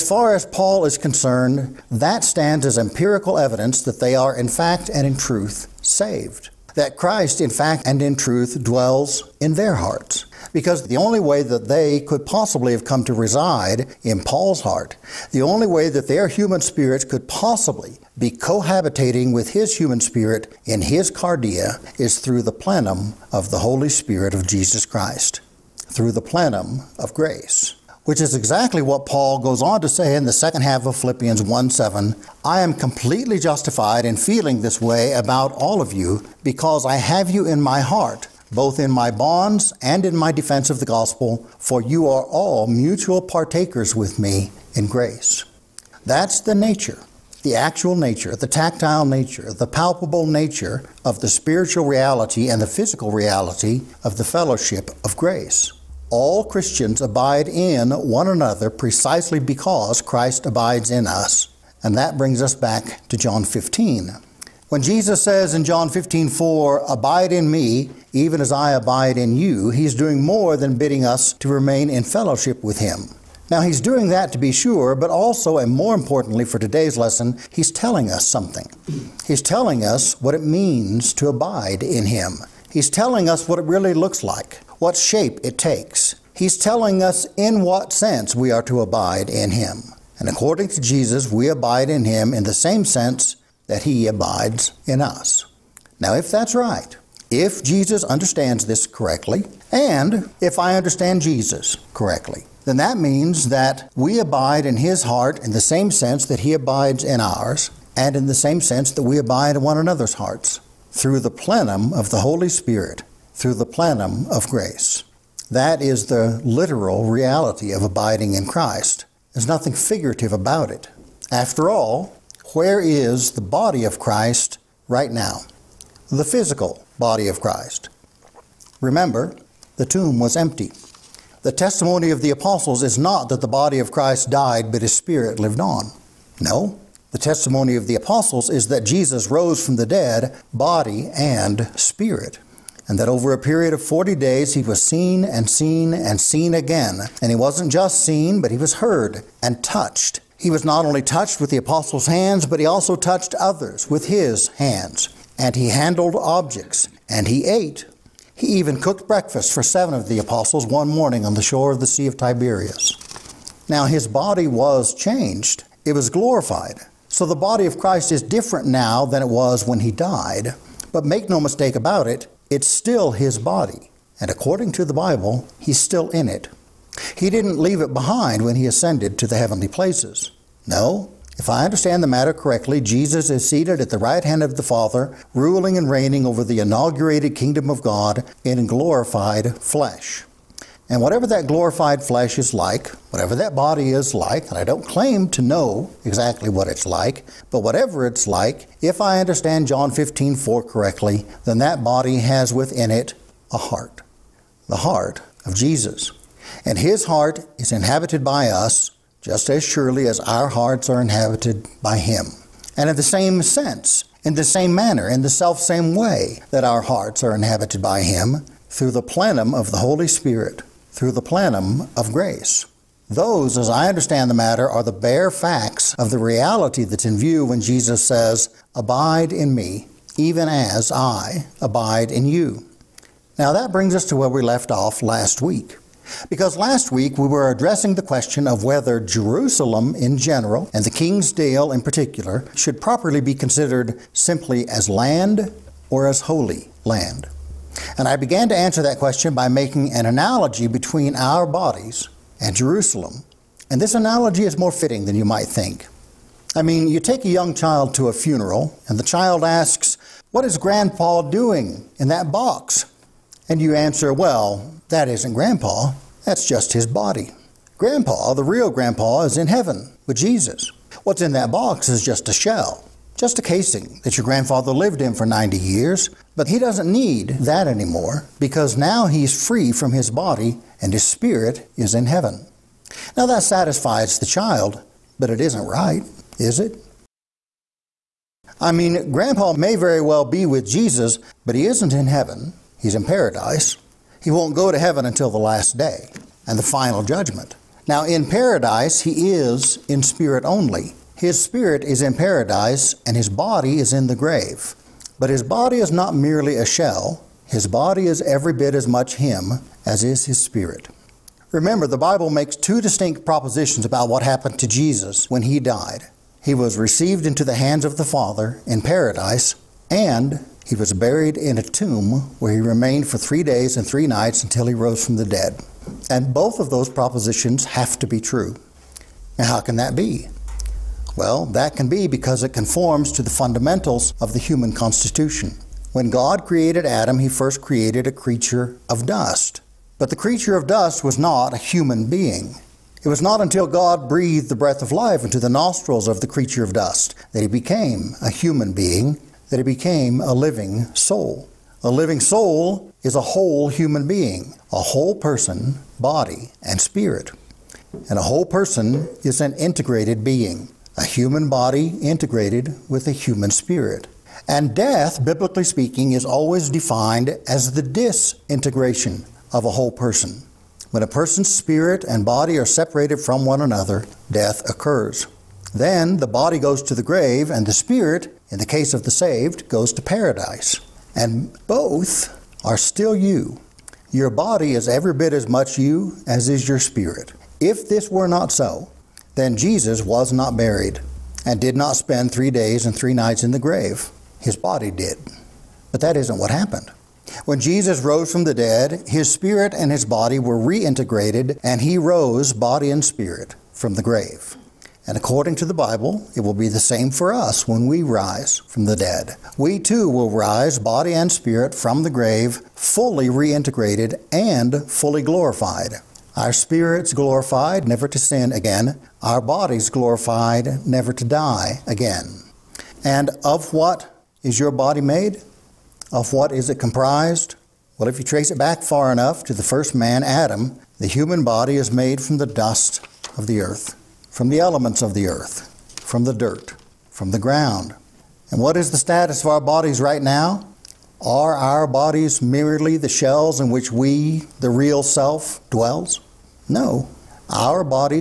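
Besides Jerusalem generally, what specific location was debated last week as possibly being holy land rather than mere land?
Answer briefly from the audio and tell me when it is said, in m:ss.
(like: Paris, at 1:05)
The King's Dale, at 4:00.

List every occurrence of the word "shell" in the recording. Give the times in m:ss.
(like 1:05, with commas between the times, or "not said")
4:32, 5:06, 7:23.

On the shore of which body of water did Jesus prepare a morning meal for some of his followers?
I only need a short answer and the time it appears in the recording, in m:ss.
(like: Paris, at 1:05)
Sea of Tiberias, at 2:41.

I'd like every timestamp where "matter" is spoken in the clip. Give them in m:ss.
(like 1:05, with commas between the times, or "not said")
3:02, 3:44.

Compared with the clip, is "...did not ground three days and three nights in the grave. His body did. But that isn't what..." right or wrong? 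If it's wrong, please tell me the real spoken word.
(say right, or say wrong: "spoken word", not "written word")
wrong: "spend", not "ground".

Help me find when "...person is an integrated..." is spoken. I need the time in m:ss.
5:58.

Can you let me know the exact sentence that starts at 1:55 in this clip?
That is the literal reality of abiding in Christ.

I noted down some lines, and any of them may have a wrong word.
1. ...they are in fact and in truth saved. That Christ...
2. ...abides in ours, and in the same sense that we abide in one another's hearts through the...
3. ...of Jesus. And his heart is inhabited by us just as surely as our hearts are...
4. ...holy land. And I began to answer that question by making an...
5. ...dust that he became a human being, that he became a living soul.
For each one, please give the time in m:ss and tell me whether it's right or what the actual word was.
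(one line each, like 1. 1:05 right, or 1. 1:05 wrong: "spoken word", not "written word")
1. 0:03 right
2. 1:46 right
3. 3:25 right
4. 4:06 right
5. 5:46 right.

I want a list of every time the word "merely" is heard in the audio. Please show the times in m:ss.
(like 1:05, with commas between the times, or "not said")
5:06, 7:22.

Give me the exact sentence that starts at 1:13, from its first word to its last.
Now, he's doing that to be sure, but also, and more importantly for today's lesson, he's telling us something.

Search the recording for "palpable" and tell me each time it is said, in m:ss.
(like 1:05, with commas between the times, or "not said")
0:49.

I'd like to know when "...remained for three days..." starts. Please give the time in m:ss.
5:22.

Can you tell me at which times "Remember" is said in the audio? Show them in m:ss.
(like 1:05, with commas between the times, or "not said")
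2:08, 5:11.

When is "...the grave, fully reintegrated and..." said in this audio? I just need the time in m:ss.
6:52.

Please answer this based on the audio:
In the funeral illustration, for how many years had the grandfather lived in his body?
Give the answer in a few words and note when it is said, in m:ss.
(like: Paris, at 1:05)
90, at 4:35.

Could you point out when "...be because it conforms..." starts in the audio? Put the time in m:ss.
5:31.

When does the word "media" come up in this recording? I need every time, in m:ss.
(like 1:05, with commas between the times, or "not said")
not said.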